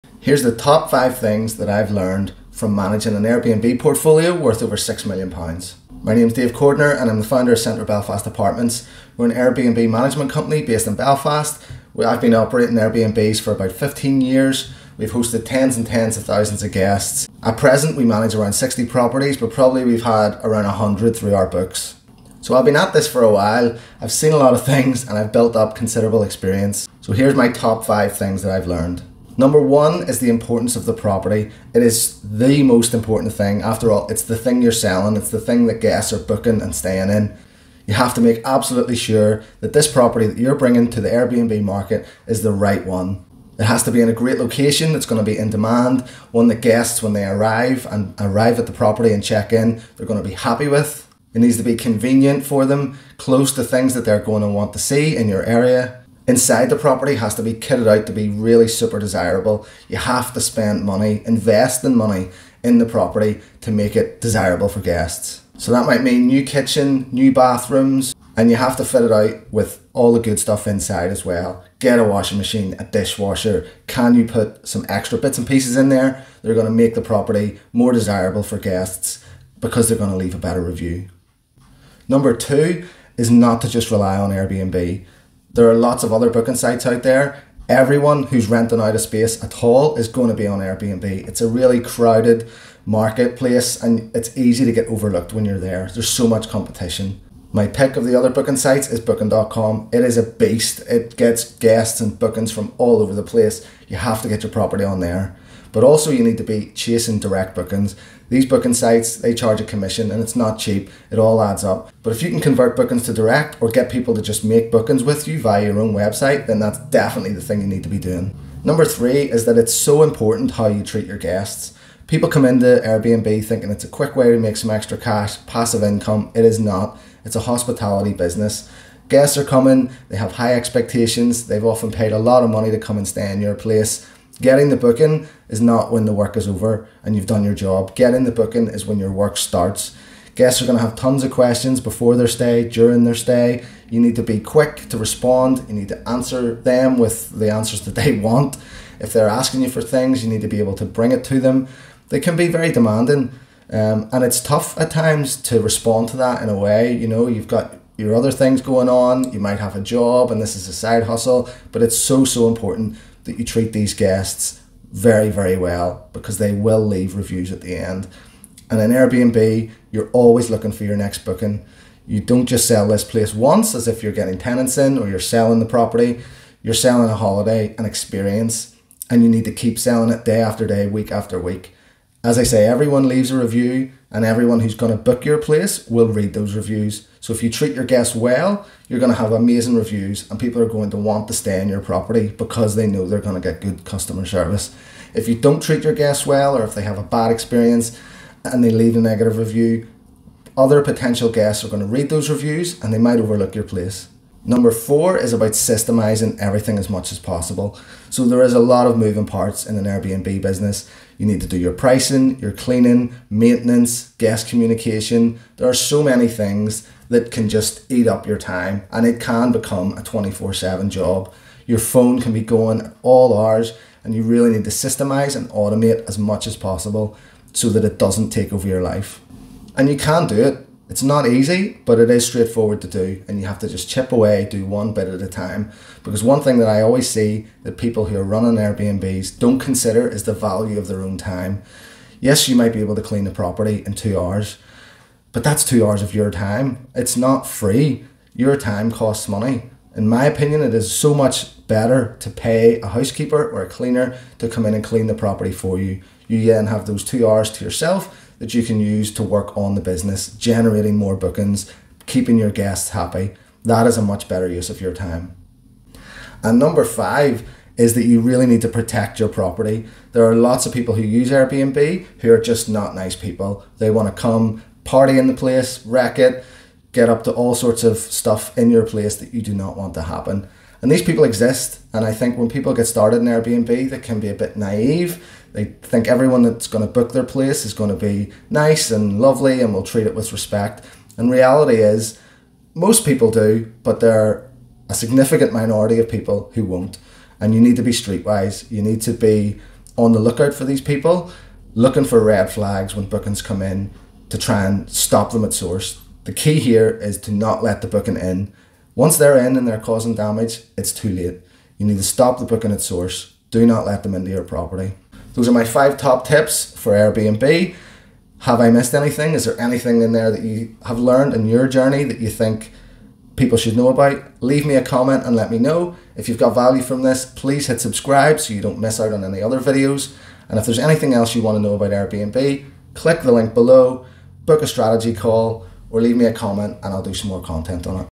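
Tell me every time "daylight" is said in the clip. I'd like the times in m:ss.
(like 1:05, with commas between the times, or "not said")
not said.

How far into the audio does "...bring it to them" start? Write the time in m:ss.
2:30.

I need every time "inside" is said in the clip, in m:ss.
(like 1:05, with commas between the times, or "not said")
0:56, 1:10.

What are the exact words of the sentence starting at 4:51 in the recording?
And reality is, most people do, but there are a significant minority of people who won't.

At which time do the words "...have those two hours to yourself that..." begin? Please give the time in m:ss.
4:16.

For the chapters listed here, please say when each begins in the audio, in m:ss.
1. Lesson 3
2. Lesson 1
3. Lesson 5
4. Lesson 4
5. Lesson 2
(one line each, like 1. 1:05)
1. 1:58
2. 0:29
3. 4:27
4. 3:25
5. 1:22.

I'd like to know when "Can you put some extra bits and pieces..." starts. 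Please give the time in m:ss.
1:13.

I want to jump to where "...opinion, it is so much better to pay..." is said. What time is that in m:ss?
4:10.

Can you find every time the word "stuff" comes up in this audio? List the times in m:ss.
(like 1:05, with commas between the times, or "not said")
1:10, 4:37.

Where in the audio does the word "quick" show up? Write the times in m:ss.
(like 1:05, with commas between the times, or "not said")
2:03, 2:24.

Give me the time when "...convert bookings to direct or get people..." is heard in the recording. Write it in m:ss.
1:52.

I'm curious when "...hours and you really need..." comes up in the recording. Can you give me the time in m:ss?
3:43.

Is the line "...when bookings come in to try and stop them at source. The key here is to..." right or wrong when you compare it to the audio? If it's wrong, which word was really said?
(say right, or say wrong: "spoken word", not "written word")
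right.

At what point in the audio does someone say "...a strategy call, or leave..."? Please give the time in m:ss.
5:34.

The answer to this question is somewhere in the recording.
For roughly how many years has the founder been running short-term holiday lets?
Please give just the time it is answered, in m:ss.
0:13.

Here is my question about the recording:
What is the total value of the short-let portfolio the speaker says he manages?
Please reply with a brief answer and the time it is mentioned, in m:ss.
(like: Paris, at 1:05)
£6 million, at 0:04.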